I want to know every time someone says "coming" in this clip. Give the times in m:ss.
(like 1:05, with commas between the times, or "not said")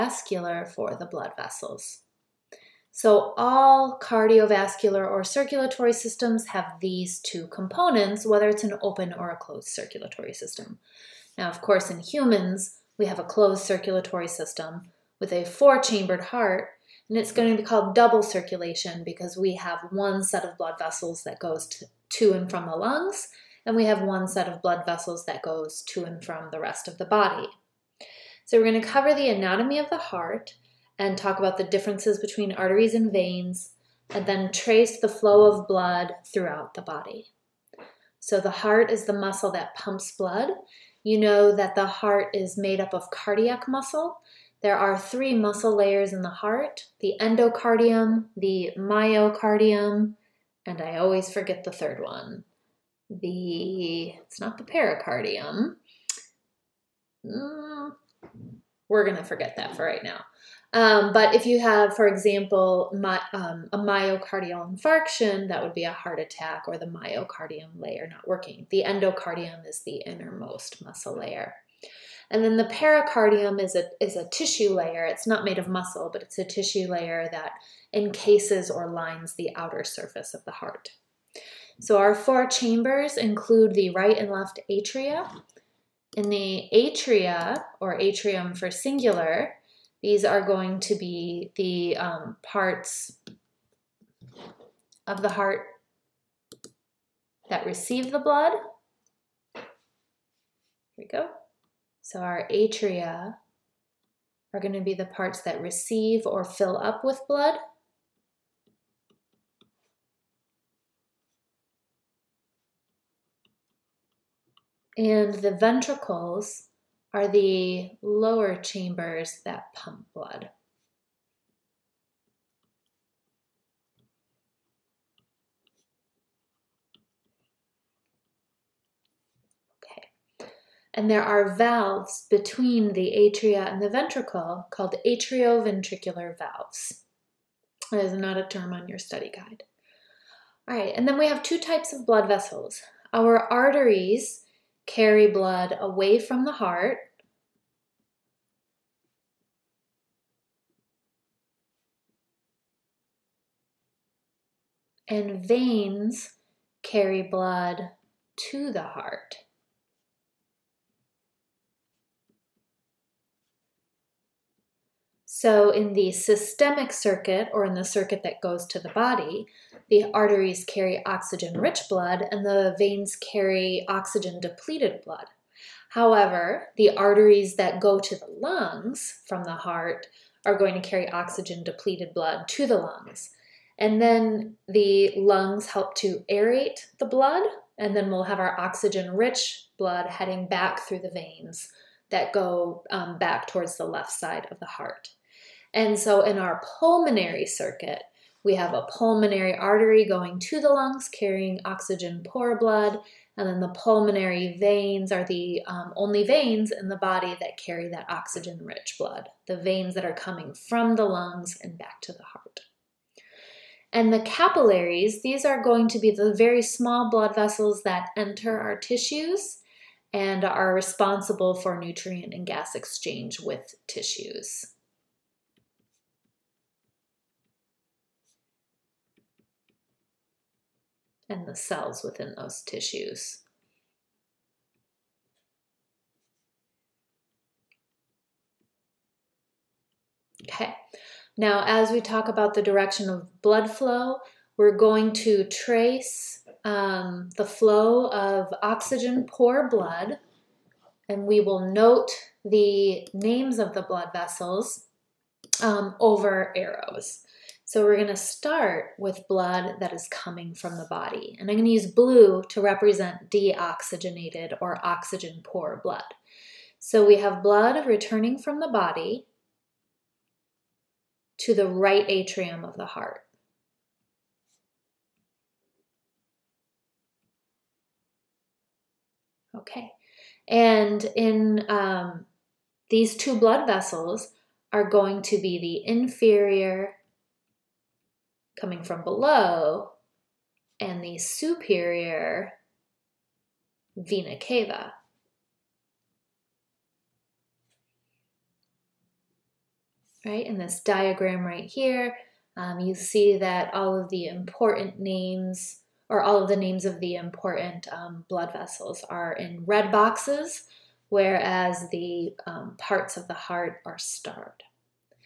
3:30, 4:20, 4:48.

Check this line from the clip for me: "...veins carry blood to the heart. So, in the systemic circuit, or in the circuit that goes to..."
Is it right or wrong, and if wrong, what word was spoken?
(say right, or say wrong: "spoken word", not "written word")
right.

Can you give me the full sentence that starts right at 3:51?
And the cells within those tissues.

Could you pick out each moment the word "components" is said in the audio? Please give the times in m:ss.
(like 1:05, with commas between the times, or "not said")
0:07.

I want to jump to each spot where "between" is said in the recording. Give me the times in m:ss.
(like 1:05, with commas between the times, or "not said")
0:32, 2:12.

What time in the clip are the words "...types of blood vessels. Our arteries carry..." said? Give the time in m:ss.
2:21.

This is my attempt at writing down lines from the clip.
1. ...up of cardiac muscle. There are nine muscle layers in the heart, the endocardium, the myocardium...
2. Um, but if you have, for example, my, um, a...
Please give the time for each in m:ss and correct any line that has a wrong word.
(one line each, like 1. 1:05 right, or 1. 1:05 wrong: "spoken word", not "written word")
1. 0:42 wrong: "three", not "nine"
2. 1:00 right.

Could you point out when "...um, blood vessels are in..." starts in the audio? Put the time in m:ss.
5:07.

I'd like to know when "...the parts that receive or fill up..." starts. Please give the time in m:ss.
1:44.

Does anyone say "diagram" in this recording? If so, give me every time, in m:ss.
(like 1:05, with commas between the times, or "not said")
5:00.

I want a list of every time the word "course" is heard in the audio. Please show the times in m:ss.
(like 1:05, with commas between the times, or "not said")
0:11.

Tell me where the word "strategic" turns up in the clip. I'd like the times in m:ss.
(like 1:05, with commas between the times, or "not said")
not said.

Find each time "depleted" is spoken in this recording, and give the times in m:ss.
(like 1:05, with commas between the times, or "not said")
2:54, 3:01.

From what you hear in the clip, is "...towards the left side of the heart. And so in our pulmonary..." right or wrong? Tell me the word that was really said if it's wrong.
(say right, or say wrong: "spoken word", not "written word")
right.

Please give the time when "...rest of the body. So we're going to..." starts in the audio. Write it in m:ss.
0:26.